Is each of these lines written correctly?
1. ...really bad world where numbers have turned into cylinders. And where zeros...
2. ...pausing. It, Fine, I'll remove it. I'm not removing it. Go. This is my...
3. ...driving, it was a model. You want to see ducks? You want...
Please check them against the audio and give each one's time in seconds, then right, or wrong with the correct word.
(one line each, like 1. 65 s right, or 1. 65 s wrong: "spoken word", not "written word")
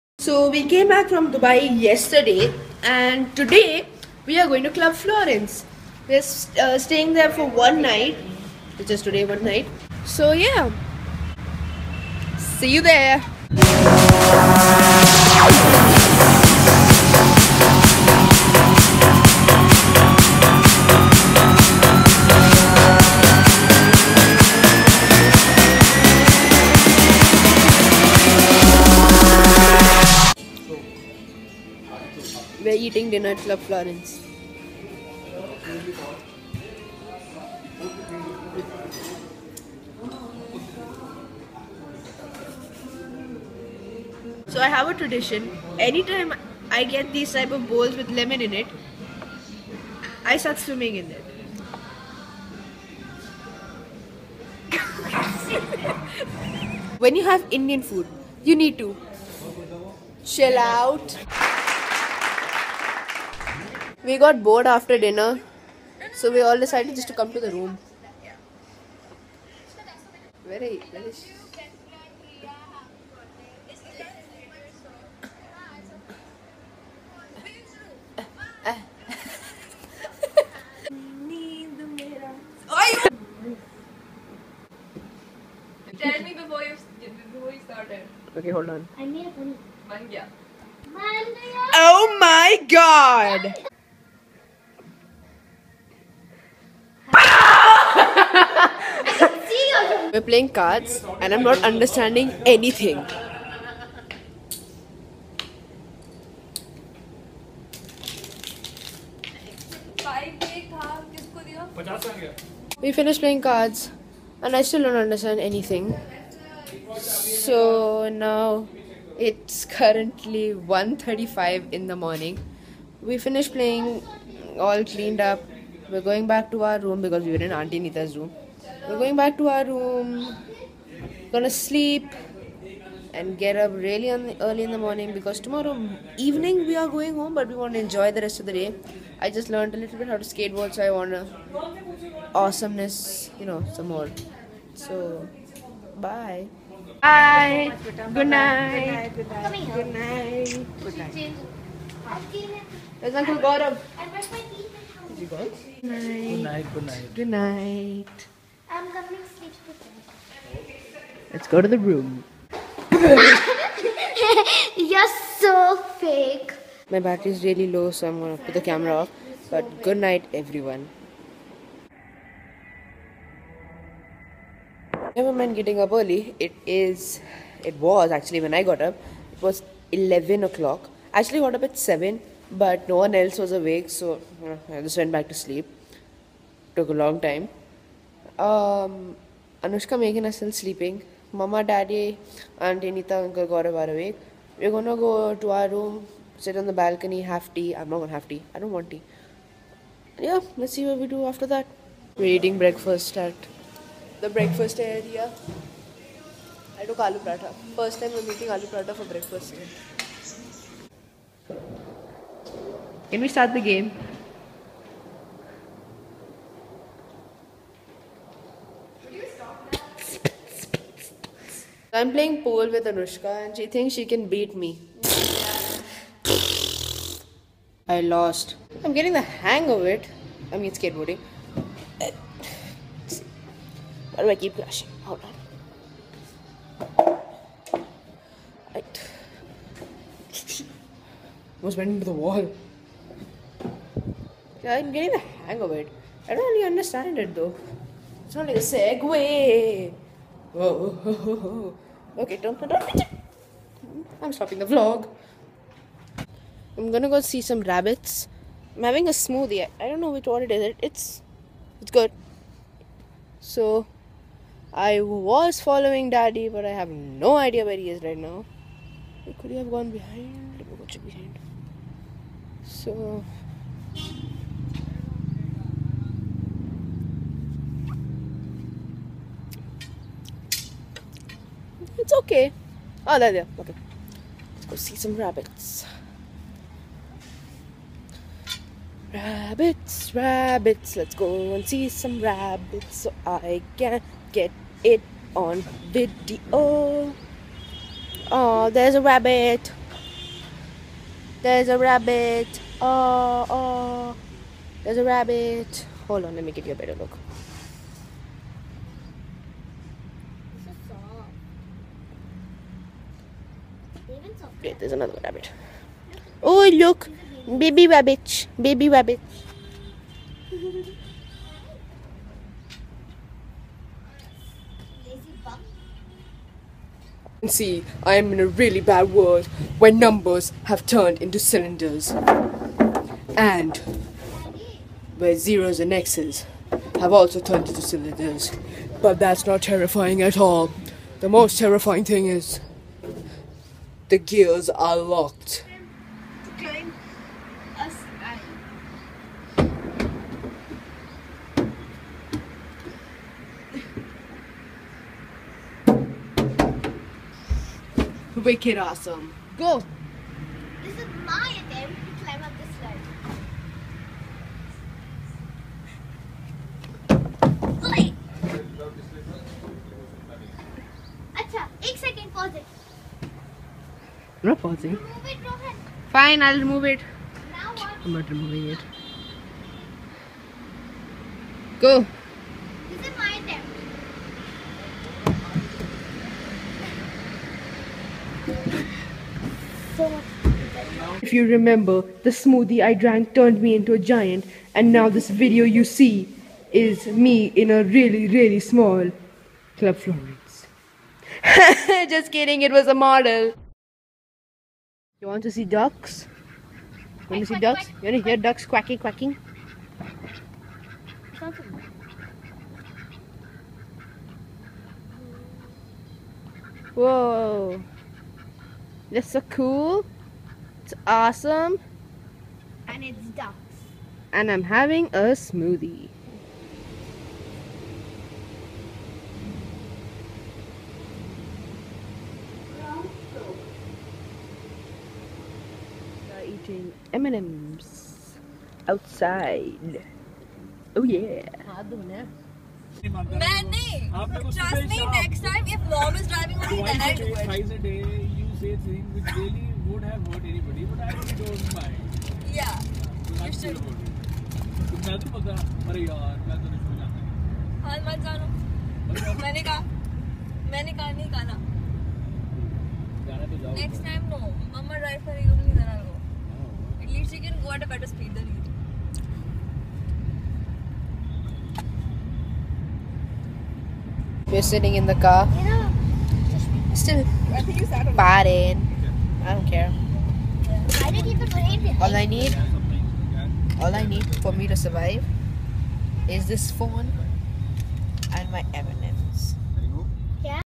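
1. 328 s right
2. 374 s right
3. 402 s wrong: "kidding", not "driving".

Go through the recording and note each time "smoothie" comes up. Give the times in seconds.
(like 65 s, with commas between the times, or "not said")
259 s, 392 s, 425 s.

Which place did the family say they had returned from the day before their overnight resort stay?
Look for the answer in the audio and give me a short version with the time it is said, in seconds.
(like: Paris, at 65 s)
Dubai, at 1 s.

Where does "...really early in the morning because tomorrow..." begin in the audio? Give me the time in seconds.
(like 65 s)
133 s.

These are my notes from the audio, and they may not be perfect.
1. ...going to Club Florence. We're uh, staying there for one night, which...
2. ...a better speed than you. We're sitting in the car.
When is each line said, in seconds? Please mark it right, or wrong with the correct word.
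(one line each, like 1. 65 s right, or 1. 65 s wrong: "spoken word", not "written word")
1. 4 s right
2. 467 s right.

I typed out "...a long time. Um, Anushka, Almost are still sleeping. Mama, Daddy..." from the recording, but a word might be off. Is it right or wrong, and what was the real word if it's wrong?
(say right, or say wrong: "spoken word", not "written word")
wrong: "Megan", not "Almost".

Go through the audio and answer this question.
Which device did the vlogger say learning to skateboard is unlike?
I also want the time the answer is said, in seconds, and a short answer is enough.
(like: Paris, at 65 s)
Segway, at 248 s.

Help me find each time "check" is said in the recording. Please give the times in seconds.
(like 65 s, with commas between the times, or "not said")
270 s.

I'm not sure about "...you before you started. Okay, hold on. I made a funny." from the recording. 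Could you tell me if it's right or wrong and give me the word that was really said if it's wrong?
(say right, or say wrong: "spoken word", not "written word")
right.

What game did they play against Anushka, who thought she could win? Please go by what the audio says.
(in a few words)
Pool.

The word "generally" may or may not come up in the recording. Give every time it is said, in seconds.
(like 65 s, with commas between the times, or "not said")
not said.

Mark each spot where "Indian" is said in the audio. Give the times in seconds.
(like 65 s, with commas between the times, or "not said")
57 s.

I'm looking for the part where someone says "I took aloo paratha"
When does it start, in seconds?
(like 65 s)
206 s.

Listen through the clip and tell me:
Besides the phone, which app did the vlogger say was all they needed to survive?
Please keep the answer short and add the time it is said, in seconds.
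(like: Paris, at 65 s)
Evernote, at 488 s.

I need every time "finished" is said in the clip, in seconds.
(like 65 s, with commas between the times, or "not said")
112 s, 123 s.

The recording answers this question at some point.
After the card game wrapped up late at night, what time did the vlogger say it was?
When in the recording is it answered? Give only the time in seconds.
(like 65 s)
120 s.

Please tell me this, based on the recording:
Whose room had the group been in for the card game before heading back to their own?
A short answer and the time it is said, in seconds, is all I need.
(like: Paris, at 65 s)
Auntie Nita's, at 127 s.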